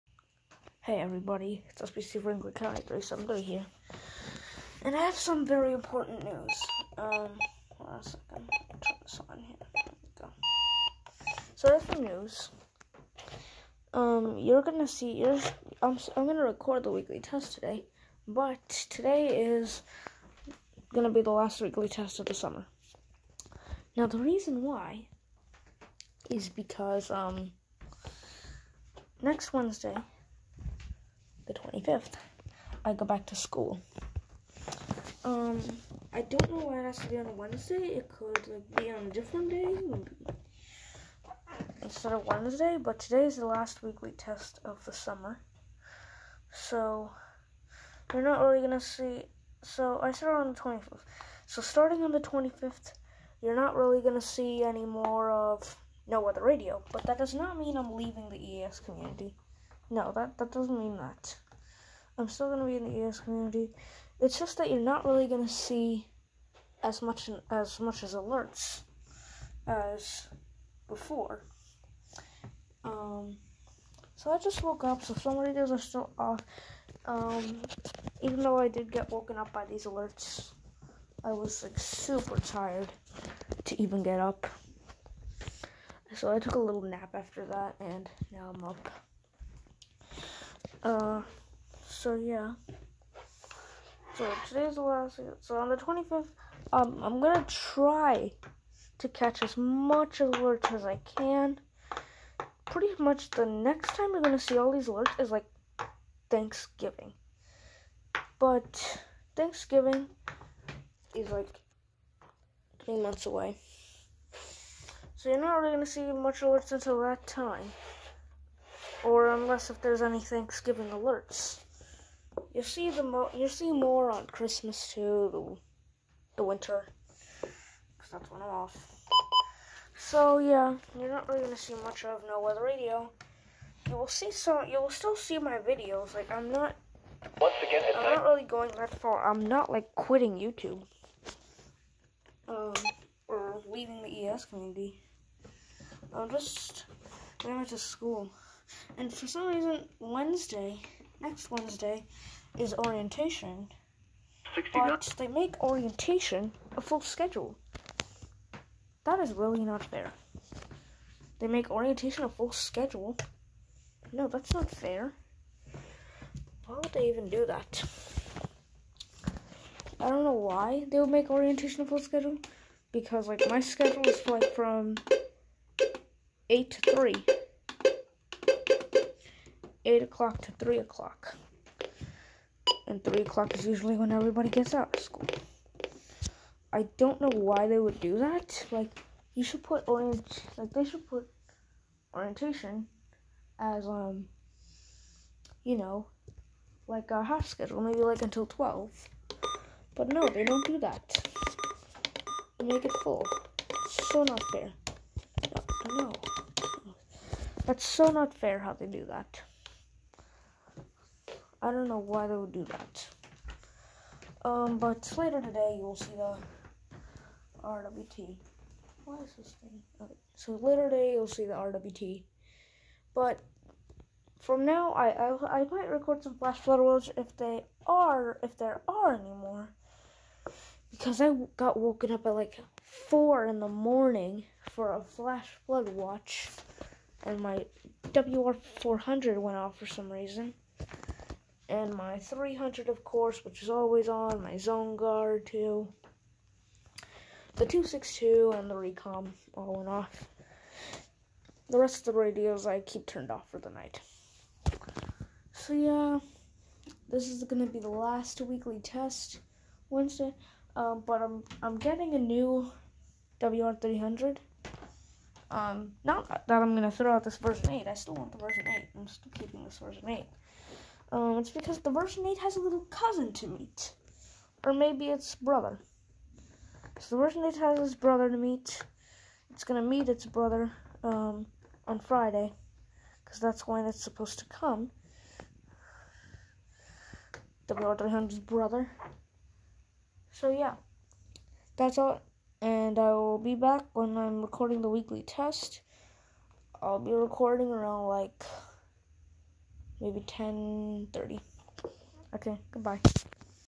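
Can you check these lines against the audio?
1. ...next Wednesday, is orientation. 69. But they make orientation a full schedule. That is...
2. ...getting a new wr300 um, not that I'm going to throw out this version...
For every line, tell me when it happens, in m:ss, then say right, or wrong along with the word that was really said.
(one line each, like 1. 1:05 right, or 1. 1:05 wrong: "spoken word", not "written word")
1. 2:31 right
2. 4:21 right.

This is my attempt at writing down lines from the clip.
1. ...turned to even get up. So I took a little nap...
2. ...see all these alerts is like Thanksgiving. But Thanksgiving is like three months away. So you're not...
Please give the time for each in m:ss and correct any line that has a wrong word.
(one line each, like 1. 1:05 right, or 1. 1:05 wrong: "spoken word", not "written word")
1. 1:22 wrong: "tired", not "turned"
2. 1:44 right.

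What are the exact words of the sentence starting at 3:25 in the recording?
No, no, that's so not fair how they do that.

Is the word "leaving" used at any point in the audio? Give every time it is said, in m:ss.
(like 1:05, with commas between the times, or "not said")
0:57, 2:23.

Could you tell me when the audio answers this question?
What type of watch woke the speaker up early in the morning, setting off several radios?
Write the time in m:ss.
3:55.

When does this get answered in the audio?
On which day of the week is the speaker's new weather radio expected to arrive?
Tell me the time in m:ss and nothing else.
4:41.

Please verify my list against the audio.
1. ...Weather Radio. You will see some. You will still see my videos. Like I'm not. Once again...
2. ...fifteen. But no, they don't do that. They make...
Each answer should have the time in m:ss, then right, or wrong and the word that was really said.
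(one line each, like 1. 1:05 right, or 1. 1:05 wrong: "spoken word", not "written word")
1. 2:12 right
2. 3:18 wrong: "twelve", not "fifteen".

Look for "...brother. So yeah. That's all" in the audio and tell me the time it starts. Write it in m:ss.
4:48.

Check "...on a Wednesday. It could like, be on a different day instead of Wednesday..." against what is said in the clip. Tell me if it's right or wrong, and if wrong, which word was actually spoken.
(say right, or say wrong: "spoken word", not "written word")
right.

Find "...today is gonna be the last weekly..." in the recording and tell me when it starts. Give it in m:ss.
0:18.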